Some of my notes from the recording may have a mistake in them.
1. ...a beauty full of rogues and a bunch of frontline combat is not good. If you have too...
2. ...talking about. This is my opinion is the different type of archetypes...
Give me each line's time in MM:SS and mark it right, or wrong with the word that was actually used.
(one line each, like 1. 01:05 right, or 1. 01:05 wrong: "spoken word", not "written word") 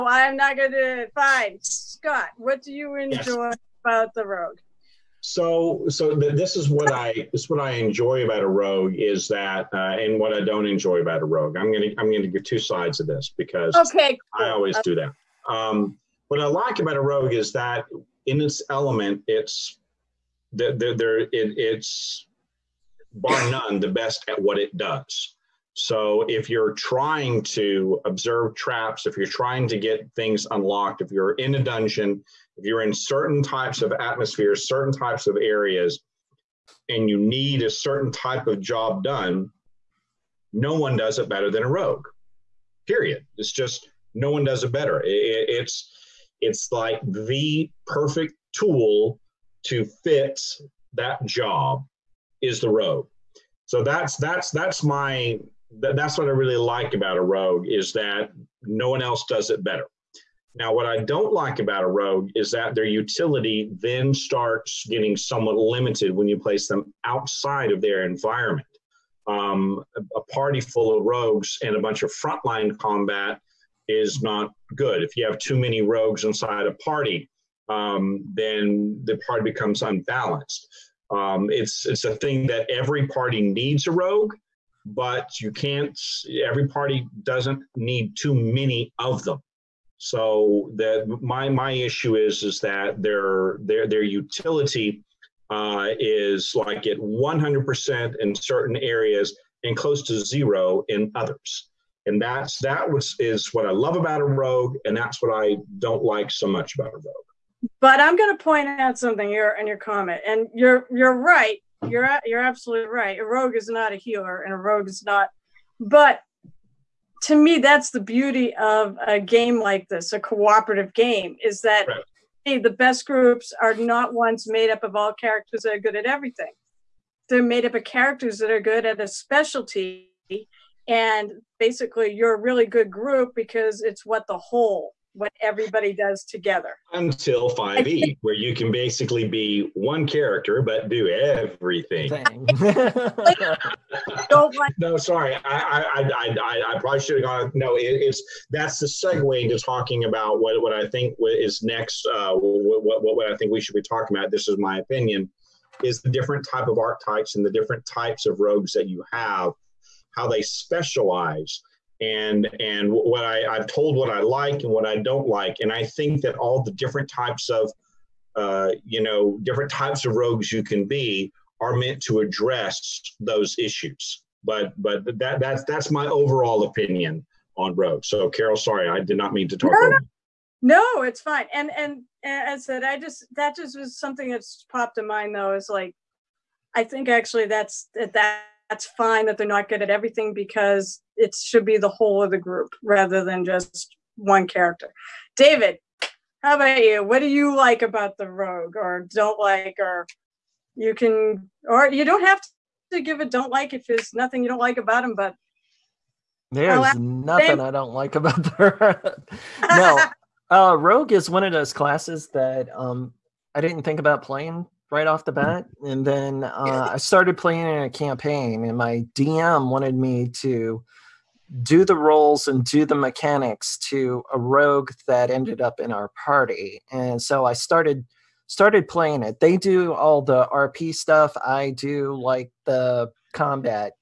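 1. 01:10 wrong: "party", not "beauty"
2. 02:33 right.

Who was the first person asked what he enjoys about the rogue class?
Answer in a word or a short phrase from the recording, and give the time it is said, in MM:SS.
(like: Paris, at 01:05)
Scott, at 00:01.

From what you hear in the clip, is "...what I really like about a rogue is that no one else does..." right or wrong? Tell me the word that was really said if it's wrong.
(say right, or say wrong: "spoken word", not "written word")
right.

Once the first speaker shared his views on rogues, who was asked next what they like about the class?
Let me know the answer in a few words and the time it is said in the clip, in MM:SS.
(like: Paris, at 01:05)
David, at 03:15.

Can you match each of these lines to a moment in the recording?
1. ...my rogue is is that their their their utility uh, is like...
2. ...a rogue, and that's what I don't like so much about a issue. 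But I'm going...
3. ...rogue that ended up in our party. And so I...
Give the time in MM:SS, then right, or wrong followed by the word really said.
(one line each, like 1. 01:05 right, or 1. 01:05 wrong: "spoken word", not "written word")
1. 01:31 wrong: "issue", not "rogue"
2. 01:44 wrong: "rogue", not "issue"
3. 03:44 right.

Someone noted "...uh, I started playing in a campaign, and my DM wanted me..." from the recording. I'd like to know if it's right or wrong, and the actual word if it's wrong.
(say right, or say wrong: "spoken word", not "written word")
right.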